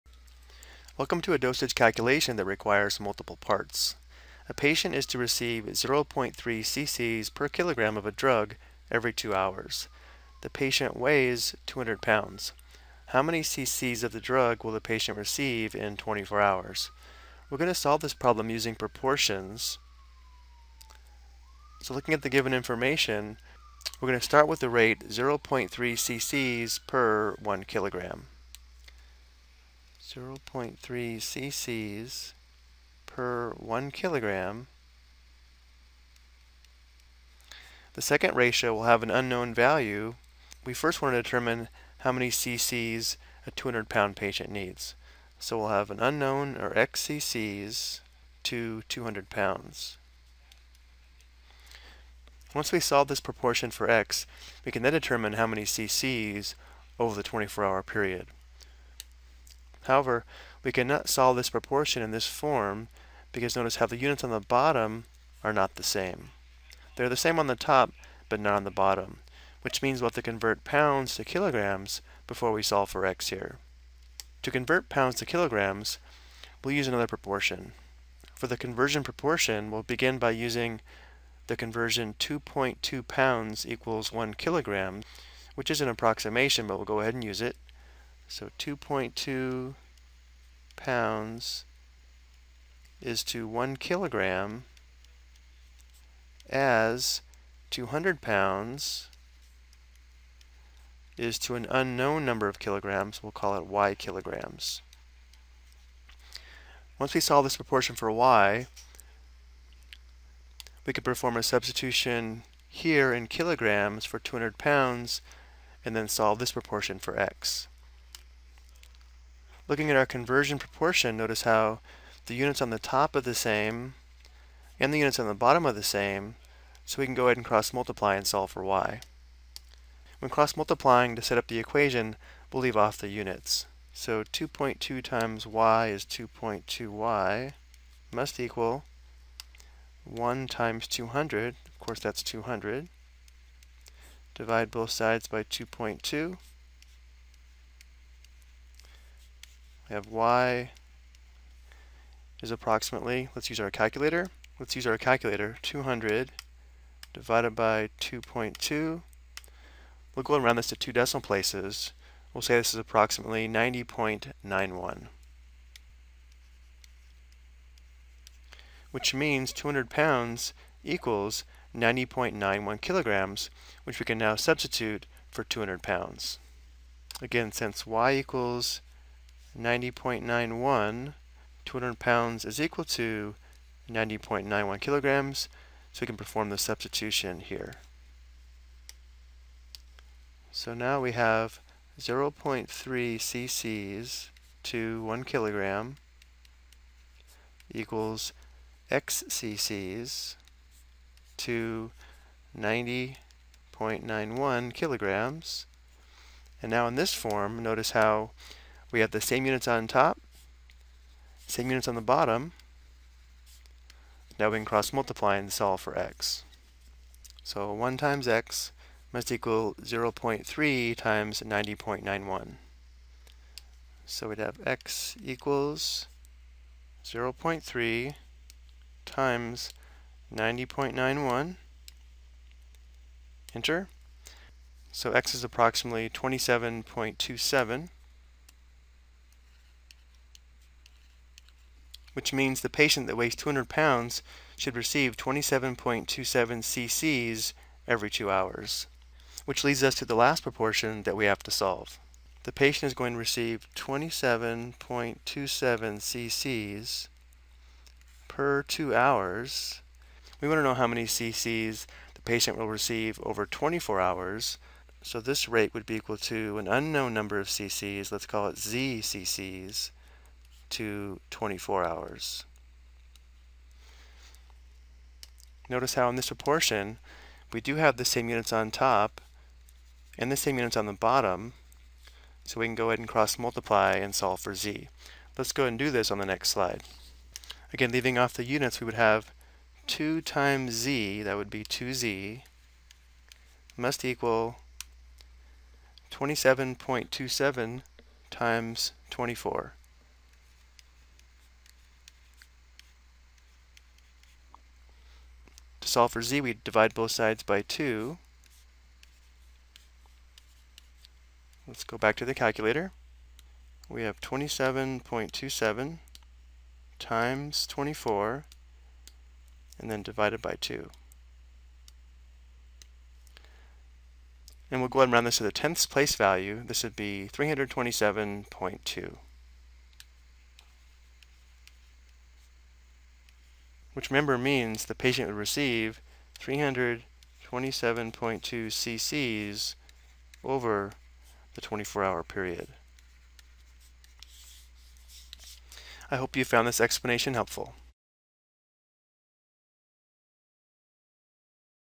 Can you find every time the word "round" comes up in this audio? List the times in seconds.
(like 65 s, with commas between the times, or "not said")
160 s, 325 s.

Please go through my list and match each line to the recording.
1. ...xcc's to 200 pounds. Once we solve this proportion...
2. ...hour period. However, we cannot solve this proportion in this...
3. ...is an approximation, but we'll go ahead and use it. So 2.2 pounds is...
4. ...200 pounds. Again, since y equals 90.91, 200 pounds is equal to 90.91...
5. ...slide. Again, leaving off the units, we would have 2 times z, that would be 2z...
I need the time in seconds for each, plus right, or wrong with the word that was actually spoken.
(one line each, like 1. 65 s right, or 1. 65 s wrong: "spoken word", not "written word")
1. 46 s right
2. 57 s right
3. 85 s right
4. 175 s right
5. 286 s right.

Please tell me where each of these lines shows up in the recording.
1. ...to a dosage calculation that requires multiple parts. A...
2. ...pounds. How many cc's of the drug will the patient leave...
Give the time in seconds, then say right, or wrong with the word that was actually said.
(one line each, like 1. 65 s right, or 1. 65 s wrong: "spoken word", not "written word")
1. 1 s right
2. 12 s wrong: "receive", not "leave".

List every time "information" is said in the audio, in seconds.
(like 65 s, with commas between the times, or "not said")
22 s.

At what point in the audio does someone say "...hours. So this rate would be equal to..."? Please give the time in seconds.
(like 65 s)
264 s.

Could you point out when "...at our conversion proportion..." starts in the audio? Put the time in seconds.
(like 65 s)
119 s.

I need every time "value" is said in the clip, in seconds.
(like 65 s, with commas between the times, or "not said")
39 s, 326 s.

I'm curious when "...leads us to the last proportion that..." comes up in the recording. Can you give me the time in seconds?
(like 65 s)
249 s.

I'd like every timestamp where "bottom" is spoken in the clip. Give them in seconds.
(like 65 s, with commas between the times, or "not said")
64 s, 68 s, 125 s, 212 s, 280 s.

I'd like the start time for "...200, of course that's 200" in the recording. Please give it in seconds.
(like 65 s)
140 s.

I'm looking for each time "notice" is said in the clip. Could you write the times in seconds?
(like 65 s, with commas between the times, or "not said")
63 s, 121 s, 207 s, 275 s.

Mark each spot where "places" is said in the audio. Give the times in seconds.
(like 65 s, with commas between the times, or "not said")
161 s, 325 s.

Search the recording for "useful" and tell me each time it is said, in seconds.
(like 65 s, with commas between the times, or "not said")
not said.